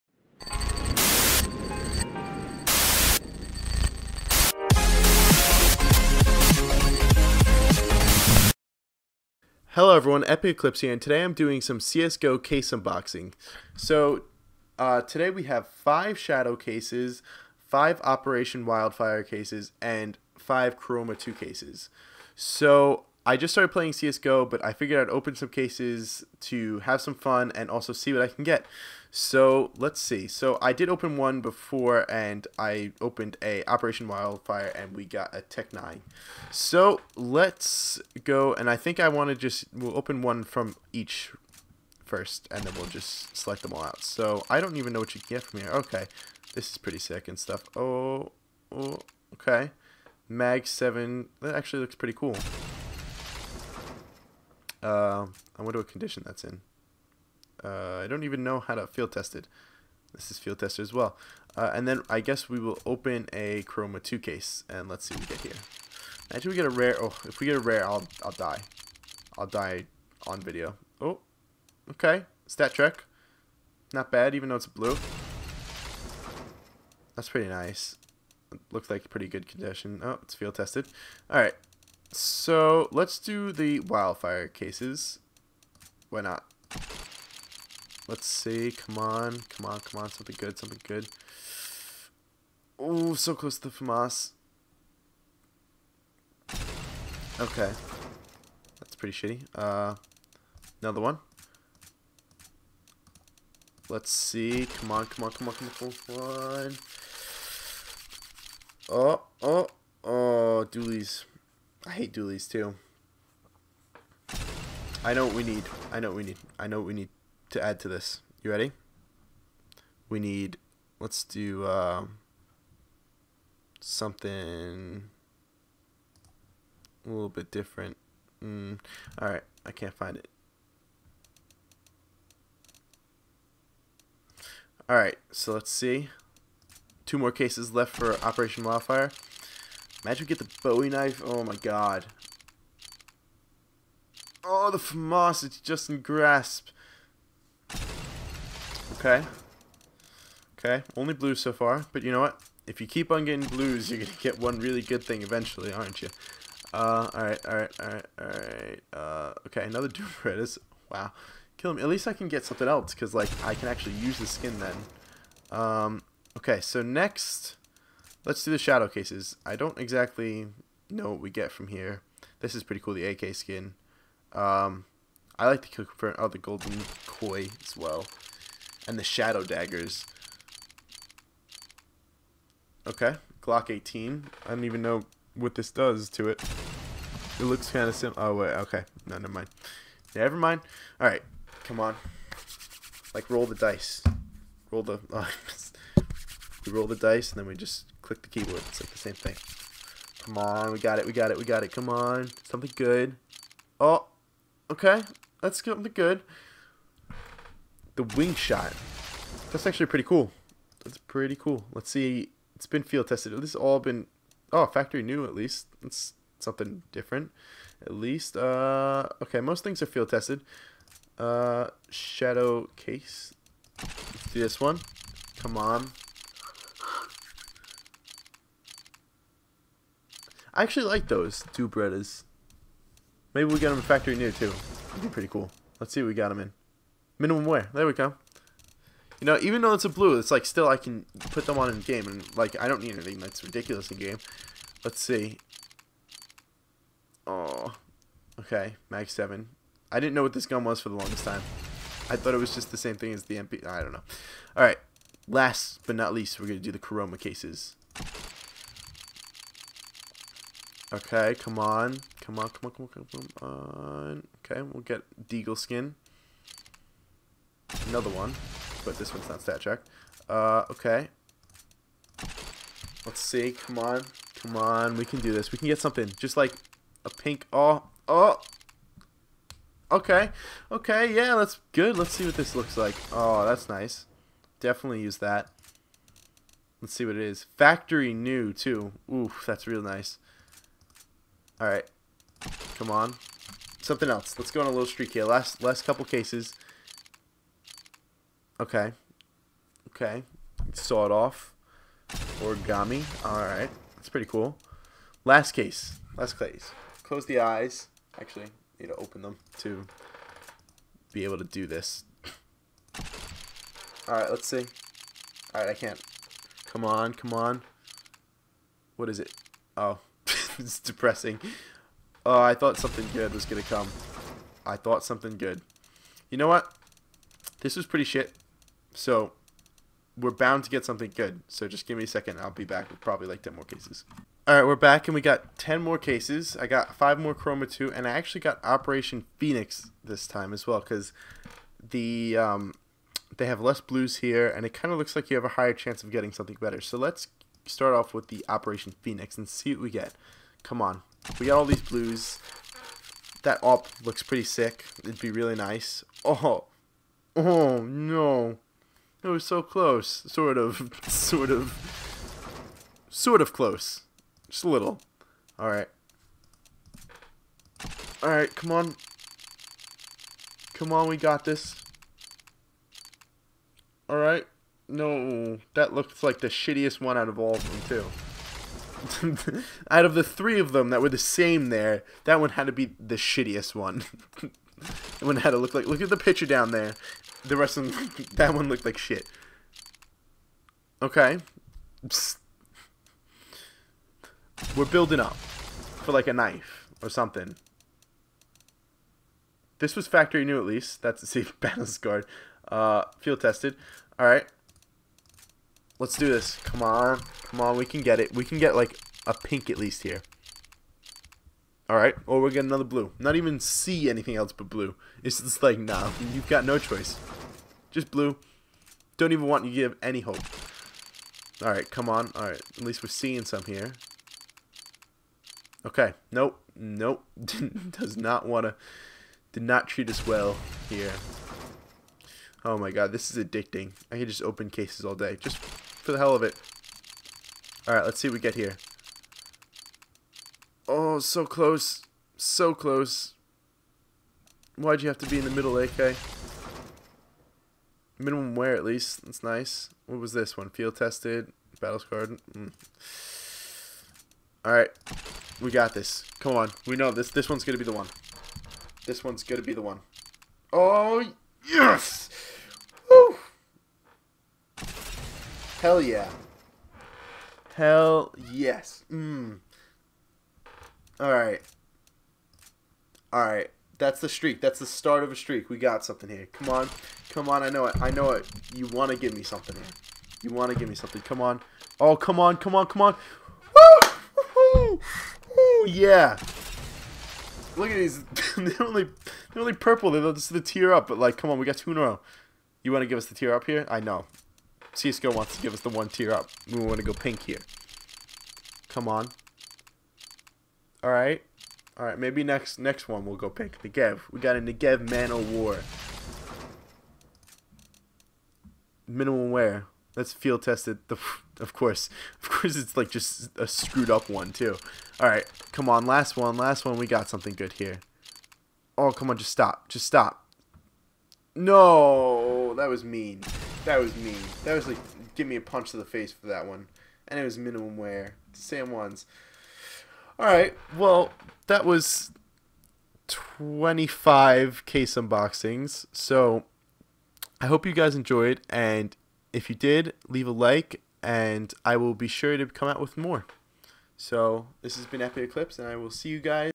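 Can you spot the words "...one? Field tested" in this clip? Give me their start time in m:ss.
7:30.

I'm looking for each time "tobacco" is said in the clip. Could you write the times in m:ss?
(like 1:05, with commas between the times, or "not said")
not said.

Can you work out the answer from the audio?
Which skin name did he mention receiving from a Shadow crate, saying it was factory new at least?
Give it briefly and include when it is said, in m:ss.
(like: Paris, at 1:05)
Wing shot, at 3:27.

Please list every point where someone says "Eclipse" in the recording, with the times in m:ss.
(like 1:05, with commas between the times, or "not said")
0:10, 9:05.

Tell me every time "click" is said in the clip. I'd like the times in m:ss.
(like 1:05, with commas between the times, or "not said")
3:18.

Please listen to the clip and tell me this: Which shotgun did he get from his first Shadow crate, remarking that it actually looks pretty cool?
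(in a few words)
Mag 7.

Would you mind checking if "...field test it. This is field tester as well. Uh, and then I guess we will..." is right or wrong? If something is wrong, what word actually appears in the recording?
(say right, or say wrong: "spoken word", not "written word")
right.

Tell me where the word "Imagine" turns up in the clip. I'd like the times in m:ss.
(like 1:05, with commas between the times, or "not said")
1:06, 2:20.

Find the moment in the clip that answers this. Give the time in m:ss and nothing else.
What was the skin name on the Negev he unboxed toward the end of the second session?
8:25.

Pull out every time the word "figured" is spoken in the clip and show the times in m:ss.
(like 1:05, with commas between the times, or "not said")
0:24.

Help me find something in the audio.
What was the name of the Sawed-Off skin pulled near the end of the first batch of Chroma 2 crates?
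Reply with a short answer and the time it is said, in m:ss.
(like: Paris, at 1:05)
Origami, at 5:02.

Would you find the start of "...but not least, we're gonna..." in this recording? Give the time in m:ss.
4:15.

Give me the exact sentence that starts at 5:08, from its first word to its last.
Actually, need to open them to be able to do this.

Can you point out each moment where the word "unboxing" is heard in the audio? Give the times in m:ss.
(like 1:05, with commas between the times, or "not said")
0:12, 8:55.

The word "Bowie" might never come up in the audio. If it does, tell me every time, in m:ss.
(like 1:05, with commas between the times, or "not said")
2:20.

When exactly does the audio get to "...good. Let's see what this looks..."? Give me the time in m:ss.
4:41.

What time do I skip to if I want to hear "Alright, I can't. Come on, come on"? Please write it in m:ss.
5:15.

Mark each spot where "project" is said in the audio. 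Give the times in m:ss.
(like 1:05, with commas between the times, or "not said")
not said.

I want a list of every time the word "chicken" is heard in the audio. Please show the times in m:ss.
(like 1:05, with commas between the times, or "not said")
not said.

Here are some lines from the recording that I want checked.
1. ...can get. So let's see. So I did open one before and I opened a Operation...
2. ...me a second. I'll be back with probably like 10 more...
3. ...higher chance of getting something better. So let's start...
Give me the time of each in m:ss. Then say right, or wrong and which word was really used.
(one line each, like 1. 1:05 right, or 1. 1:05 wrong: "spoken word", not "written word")
1. 0:28 right
2. 5:31 right
3. 5:45 right.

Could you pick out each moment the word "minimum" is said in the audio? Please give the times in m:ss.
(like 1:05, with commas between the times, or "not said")
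3:57, 7:28, 8:29, 8:47.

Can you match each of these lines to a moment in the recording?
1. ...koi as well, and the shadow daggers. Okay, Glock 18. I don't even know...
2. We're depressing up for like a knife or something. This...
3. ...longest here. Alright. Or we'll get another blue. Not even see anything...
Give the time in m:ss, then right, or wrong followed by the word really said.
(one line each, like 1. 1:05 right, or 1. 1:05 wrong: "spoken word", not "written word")
1. 2:57 right
2. 6:34 wrong: "building", not "depressing"
3. 6:49 wrong: "least", not "longest".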